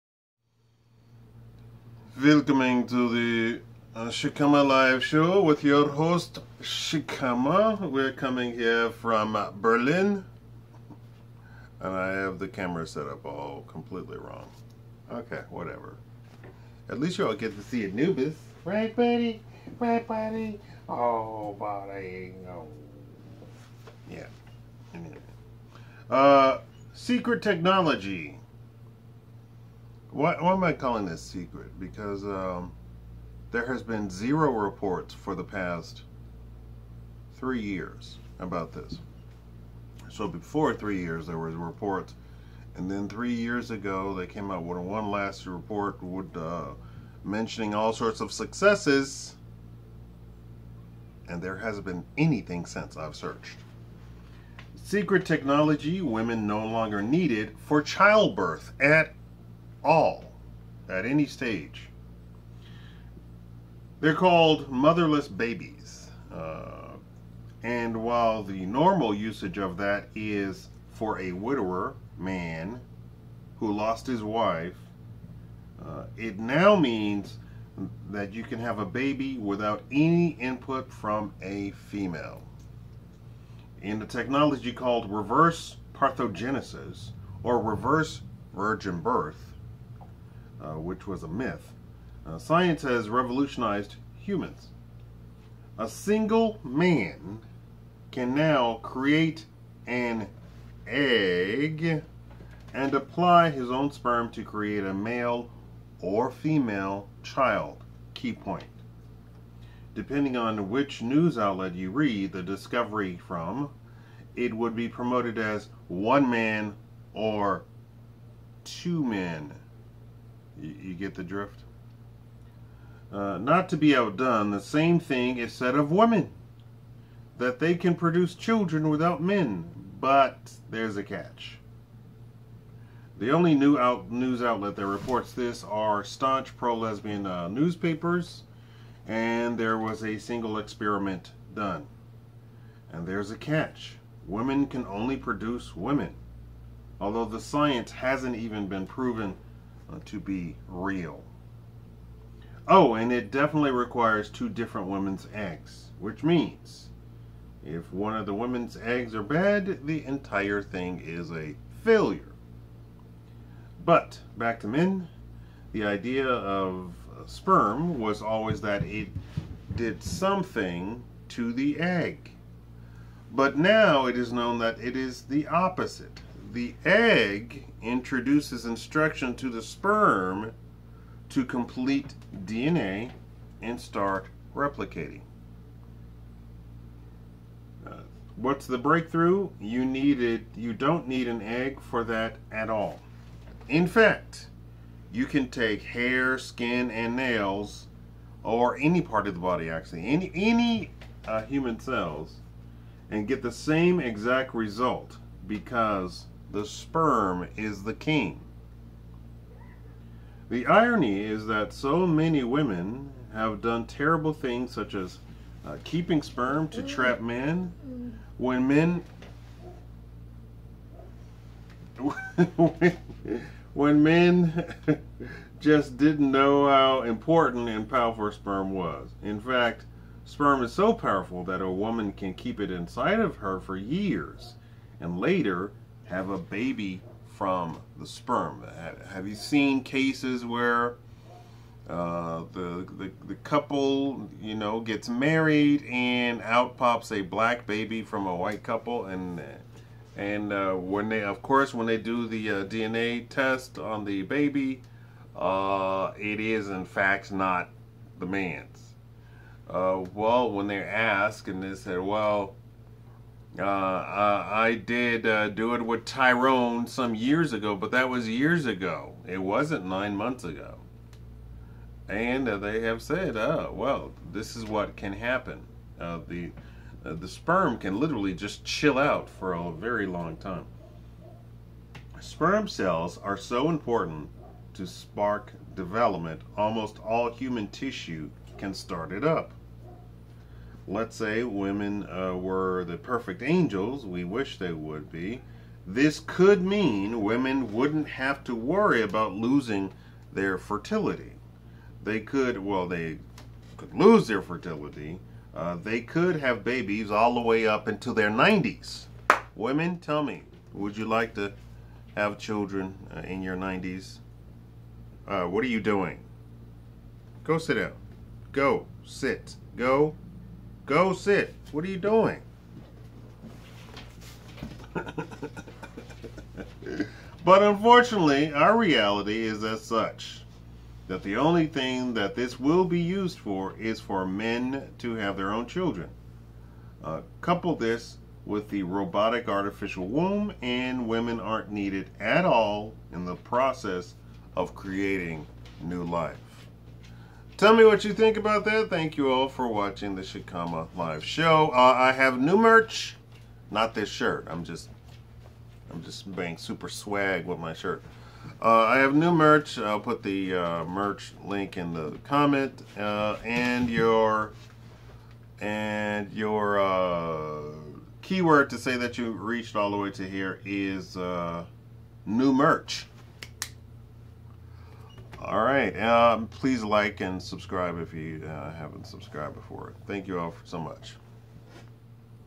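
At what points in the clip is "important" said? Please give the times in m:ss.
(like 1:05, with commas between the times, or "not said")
3:47, 4:43.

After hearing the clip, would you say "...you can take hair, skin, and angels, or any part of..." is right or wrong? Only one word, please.
wrong.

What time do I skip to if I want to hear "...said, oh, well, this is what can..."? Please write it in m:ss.
4:33.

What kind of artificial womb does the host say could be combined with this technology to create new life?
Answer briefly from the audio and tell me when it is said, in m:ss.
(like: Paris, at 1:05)
robotic, at 5:38.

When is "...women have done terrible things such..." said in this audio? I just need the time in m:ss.
3:32.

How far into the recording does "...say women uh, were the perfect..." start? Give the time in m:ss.
4:51.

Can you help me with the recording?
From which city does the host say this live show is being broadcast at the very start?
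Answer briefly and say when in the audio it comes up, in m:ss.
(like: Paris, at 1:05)
Berlin, at 0:09.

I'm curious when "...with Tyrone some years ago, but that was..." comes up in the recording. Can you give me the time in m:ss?
4:25.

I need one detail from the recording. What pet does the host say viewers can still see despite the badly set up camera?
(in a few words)
Anubis.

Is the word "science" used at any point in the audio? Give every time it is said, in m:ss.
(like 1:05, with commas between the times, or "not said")
1:32, 2:27.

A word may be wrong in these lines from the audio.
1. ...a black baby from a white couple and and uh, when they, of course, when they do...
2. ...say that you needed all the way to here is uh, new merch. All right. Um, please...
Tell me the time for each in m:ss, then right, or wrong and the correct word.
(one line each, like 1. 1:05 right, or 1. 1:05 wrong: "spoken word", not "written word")
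1. 4:07 right
2. 6:08 wrong: "reached", not "needed".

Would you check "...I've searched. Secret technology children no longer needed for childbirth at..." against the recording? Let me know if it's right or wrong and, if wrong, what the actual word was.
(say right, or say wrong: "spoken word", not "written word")
wrong: "women", not "children".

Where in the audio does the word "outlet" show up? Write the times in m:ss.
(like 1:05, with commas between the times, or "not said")
1:51, 2:14.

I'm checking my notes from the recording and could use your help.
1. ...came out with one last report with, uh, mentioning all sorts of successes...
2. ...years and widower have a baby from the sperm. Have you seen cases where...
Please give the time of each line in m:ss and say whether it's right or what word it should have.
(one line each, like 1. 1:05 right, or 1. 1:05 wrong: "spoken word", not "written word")
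1. 0:44 right
2. 3:53 wrong: "later", not "widower".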